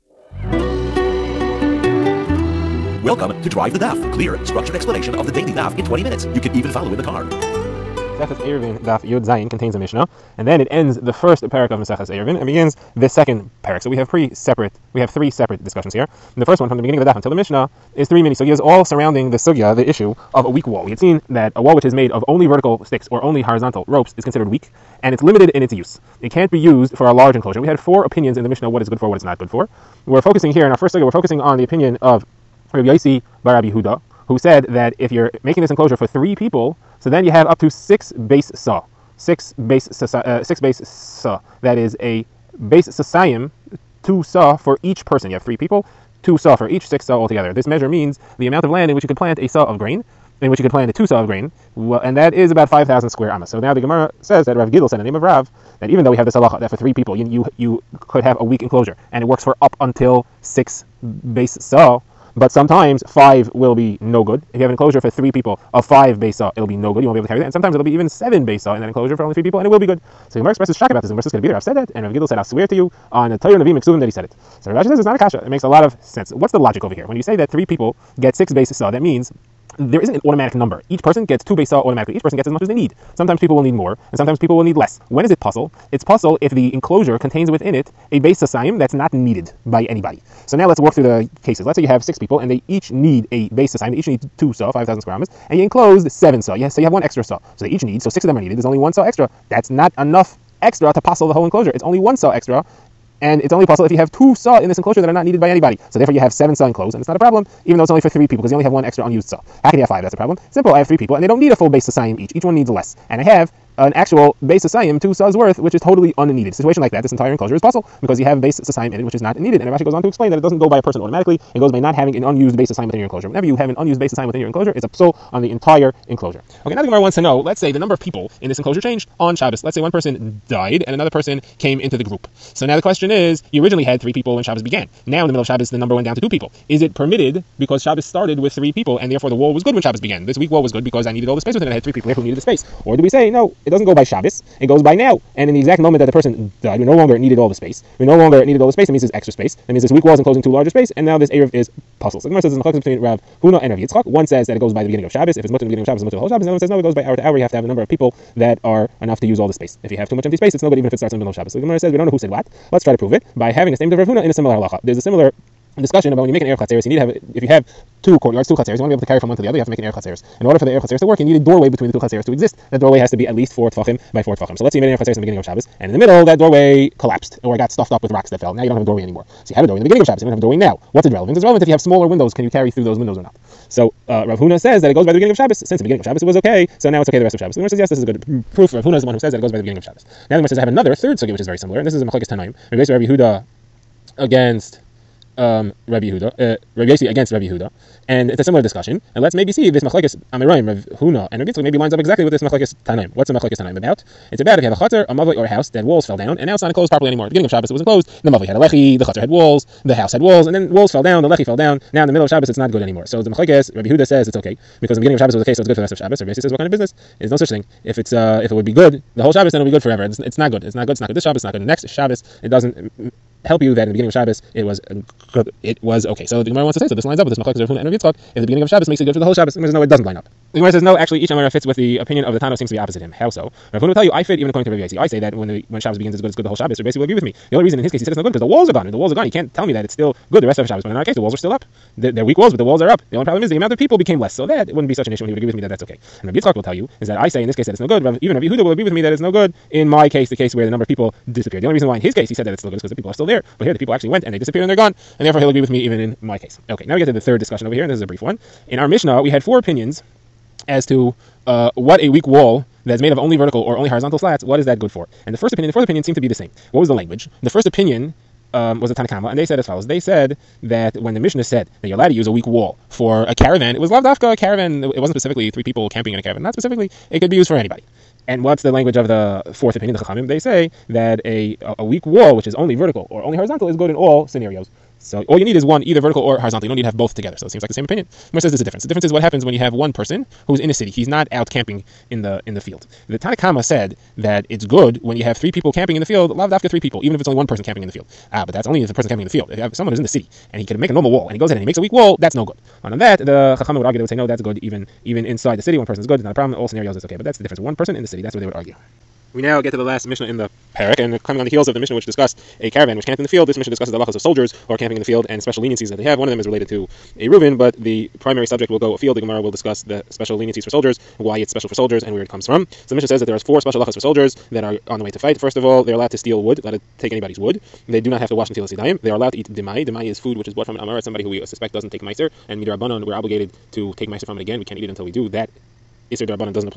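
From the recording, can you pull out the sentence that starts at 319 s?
The Gemara will discuss the special leniencies for soldiers, why it's special for soldiers, and where it comes from.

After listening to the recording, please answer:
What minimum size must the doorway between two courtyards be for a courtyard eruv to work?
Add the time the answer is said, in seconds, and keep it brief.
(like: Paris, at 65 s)
4 tefachim by 4 tefachim, at 173 s.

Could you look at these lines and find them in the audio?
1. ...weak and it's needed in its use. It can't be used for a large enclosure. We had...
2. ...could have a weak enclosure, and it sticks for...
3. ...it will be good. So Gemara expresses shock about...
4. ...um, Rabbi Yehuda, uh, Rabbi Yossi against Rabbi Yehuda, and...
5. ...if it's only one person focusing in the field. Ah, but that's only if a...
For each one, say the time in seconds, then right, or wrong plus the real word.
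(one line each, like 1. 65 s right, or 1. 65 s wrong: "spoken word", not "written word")
1. 24 s wrong: "limited", not "needed"
2. 58 s wrong: "works", not "sticks"
3. 69 s right
4. 195 s right
5. 297 s wrong: "camping", not "focusing".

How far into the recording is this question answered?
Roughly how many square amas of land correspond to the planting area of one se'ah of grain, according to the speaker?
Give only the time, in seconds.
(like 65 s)
52 s.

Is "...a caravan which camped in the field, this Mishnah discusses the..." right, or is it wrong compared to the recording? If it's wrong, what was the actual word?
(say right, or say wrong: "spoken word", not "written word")
right.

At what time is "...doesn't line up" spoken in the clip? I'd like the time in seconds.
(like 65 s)
229 s.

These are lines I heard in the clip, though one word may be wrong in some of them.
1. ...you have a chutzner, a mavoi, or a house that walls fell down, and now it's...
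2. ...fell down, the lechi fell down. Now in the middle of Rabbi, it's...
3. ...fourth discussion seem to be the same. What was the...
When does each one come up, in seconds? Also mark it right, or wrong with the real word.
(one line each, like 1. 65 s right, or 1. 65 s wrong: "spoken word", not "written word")
1. 204 s right
2. 210 s wrong: "Shabbos", not "Rabbi"
3. 265 s wrong: "opinion", not "discussion".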